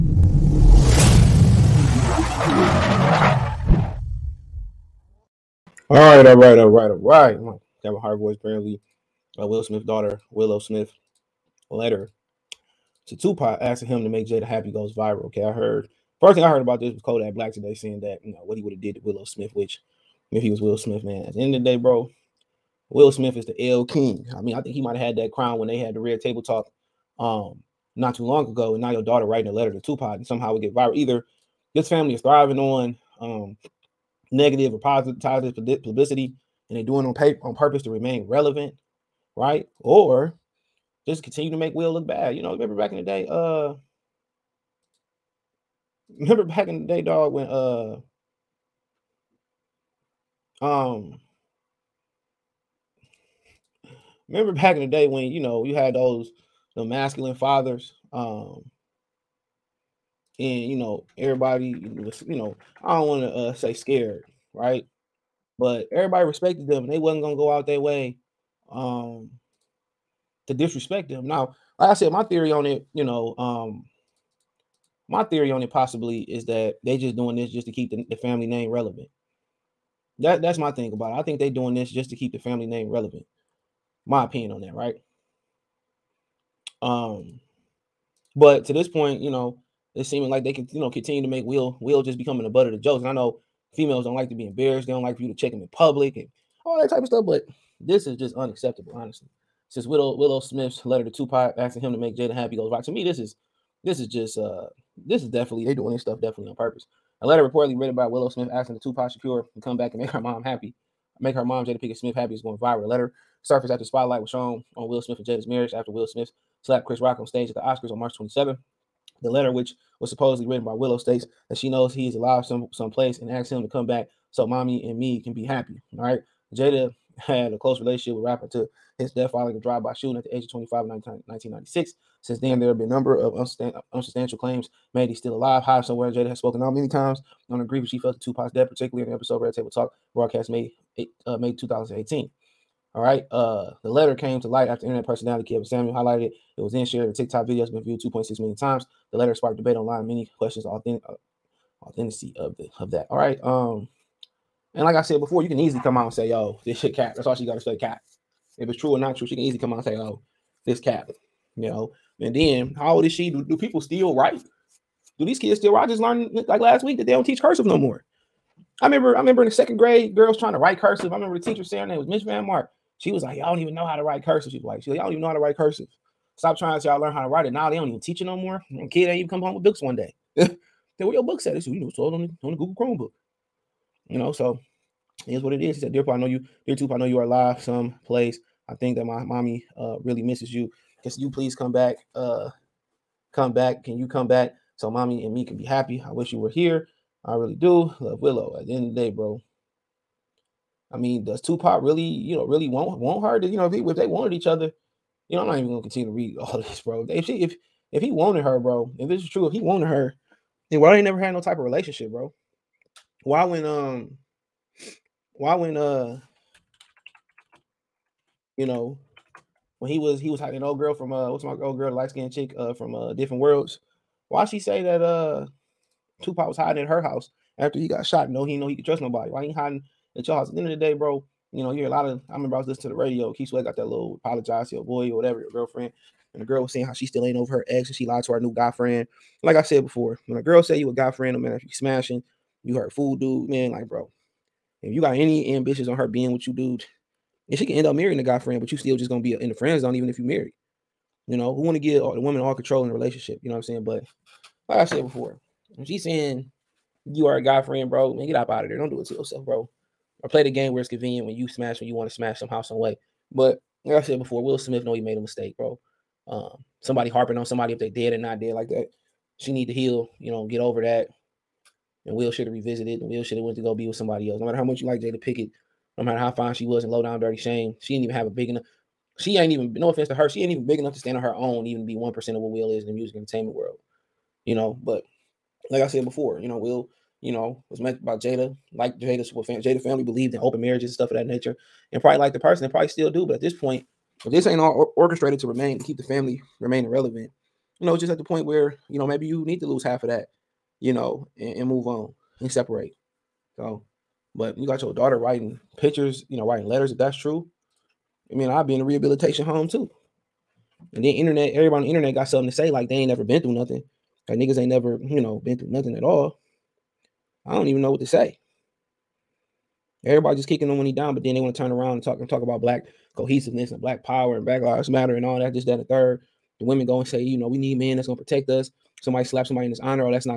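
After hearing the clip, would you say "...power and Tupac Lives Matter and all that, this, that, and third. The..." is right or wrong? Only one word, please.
wrong.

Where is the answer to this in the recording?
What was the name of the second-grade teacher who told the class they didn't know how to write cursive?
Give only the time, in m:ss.
2:52.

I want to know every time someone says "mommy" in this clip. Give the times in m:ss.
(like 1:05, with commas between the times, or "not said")
2:04, 3:09, 3:14.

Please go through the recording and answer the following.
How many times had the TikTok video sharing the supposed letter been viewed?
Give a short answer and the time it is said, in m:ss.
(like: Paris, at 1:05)
2.6 million, at 2:27.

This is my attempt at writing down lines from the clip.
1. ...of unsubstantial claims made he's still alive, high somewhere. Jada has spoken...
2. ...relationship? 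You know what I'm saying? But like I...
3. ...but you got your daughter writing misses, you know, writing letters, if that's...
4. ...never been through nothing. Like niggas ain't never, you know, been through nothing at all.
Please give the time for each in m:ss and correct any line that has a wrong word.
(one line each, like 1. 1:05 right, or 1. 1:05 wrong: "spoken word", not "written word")
1. 2:13 right
2. 4:12 right
3. 5:04 wrong: "pictures", not "misses"
4. 5:13 right.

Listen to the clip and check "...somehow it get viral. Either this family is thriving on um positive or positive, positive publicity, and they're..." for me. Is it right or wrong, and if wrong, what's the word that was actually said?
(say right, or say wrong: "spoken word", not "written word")
wrong: "negative", not "positive".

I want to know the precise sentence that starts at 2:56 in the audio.
Stop trying to y'all learn how to write it.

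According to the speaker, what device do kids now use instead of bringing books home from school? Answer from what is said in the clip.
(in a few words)
Google Chromebook.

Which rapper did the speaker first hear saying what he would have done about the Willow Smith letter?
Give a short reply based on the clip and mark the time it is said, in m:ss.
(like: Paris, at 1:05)
Kodak Black, at 0:17.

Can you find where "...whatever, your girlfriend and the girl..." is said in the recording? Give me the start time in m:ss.
3:55.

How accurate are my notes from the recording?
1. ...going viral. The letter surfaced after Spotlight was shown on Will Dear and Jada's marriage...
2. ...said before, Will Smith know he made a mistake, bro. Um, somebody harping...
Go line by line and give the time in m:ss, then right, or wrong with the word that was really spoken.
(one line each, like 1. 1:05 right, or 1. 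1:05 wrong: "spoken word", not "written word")
1. 1:52 wrong: "Smith", not "Dear"
2. 4:24 right.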